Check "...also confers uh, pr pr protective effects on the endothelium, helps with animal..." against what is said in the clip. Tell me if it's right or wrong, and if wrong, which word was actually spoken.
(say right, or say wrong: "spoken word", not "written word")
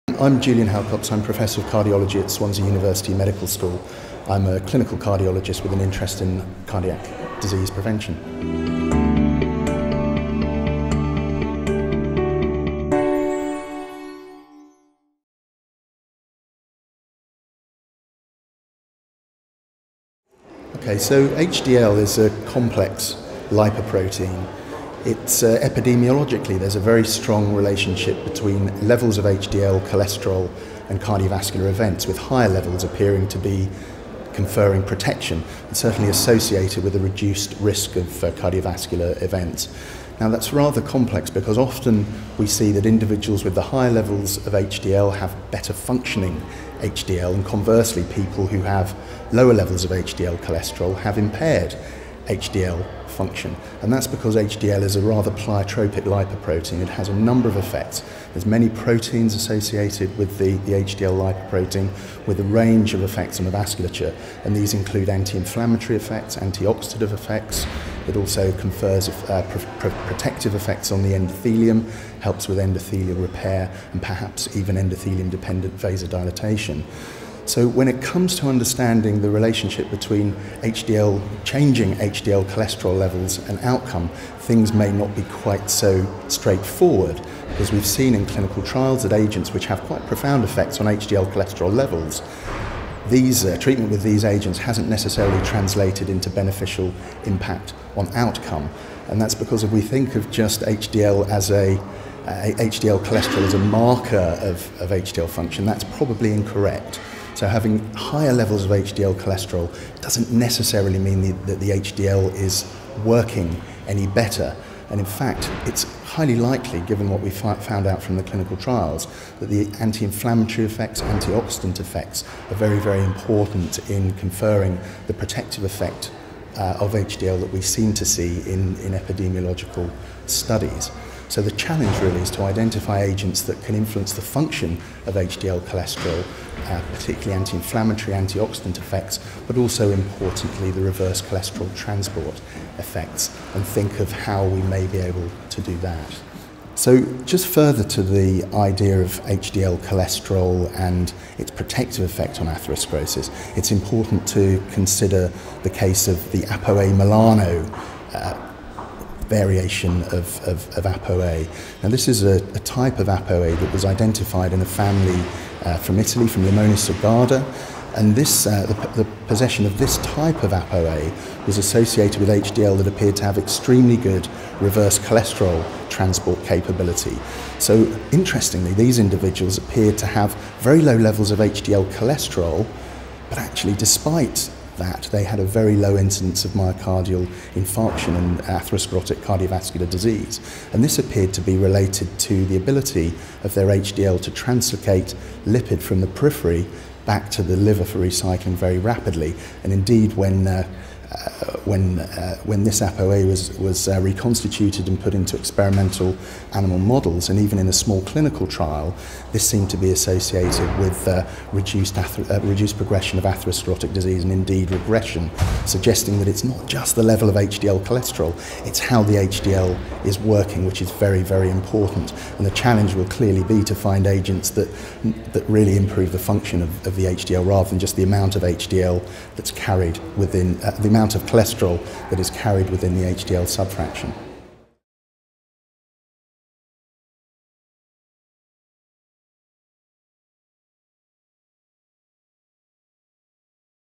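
wrong: "endothelial", not "animal".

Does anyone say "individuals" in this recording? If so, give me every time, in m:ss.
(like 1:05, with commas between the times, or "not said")
0:42, 2:58.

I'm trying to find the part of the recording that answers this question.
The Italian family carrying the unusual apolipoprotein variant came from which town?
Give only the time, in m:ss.
2:46.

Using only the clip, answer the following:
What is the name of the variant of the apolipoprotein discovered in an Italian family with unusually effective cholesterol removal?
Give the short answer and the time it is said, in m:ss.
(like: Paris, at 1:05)
ApoA Milano, at 2:36.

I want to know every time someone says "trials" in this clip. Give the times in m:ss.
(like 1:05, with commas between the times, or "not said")
1:28, 1:58, 3:28.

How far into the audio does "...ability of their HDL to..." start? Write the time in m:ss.
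3:12.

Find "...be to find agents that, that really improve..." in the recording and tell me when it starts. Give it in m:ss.
3:43.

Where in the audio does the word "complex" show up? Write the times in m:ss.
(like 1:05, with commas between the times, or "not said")
0:22, 0:40.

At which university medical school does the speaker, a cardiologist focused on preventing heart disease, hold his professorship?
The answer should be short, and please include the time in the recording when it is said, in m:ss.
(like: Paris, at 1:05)
Swansea University, at 0:02.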